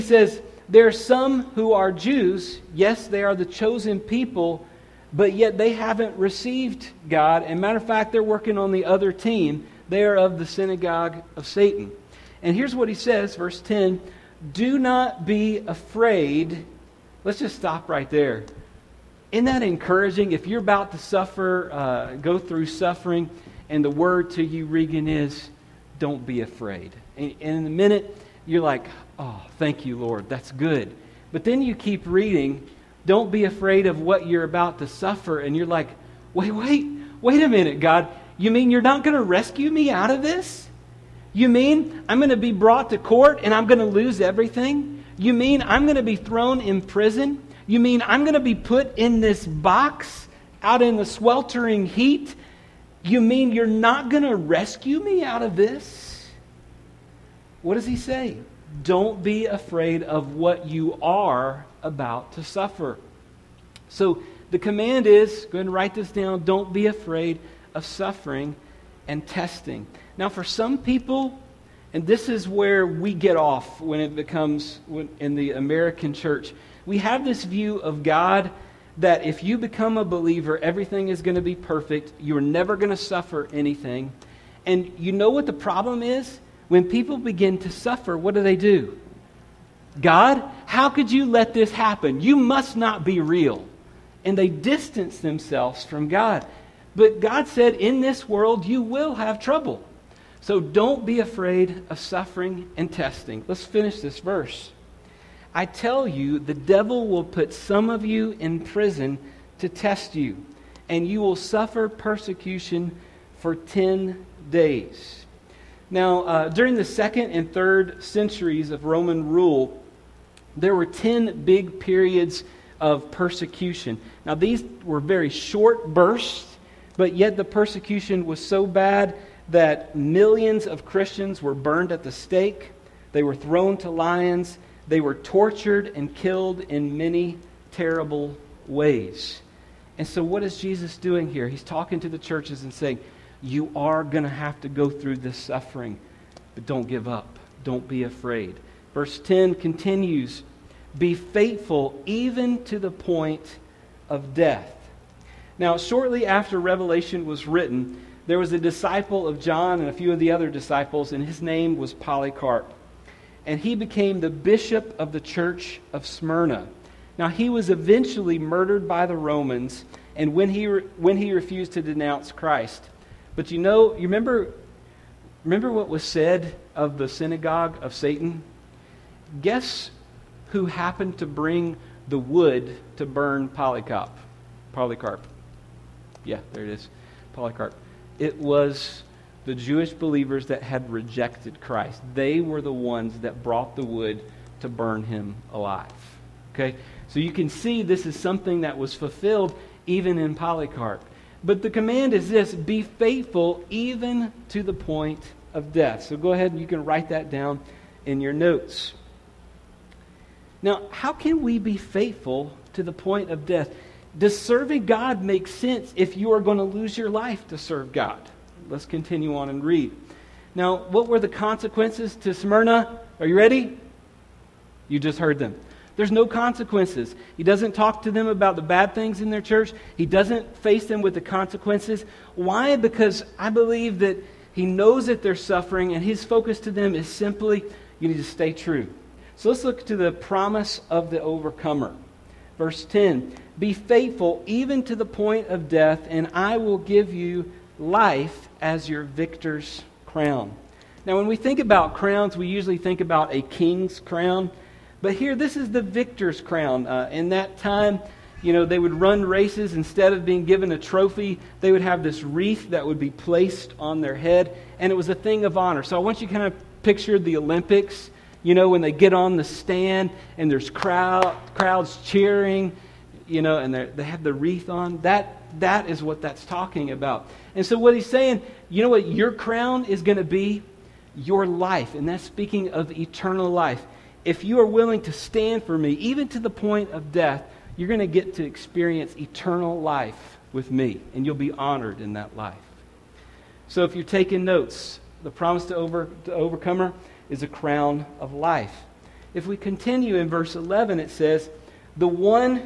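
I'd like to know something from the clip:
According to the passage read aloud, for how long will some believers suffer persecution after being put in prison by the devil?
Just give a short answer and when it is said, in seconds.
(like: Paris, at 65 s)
10 days, at 113 s.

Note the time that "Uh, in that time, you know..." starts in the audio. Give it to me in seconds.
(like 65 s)
256 s.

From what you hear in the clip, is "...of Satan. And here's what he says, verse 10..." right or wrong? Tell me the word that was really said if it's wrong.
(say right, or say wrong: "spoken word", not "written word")
right.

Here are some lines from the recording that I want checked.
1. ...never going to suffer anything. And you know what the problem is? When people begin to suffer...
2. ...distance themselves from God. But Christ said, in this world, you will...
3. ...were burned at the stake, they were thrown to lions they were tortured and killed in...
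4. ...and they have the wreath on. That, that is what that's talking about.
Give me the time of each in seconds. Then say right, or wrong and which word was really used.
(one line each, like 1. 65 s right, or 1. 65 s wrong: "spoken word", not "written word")
1. 82 s right
2. 94 s wrong: "God", not "Christ"
3. 131 s right
4. 273 s right.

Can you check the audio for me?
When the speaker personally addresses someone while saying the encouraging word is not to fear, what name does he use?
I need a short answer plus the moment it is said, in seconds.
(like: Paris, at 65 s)
Regan, at 24 s.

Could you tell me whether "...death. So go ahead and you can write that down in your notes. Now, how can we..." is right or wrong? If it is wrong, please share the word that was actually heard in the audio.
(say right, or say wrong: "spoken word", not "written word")
right.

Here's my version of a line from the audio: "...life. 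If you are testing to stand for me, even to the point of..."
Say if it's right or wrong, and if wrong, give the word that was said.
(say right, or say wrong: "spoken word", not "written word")
wrong: "willing", not "testing".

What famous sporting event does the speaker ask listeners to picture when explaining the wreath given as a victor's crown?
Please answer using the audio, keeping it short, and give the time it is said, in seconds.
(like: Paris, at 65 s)
the Olympics, at 267 s.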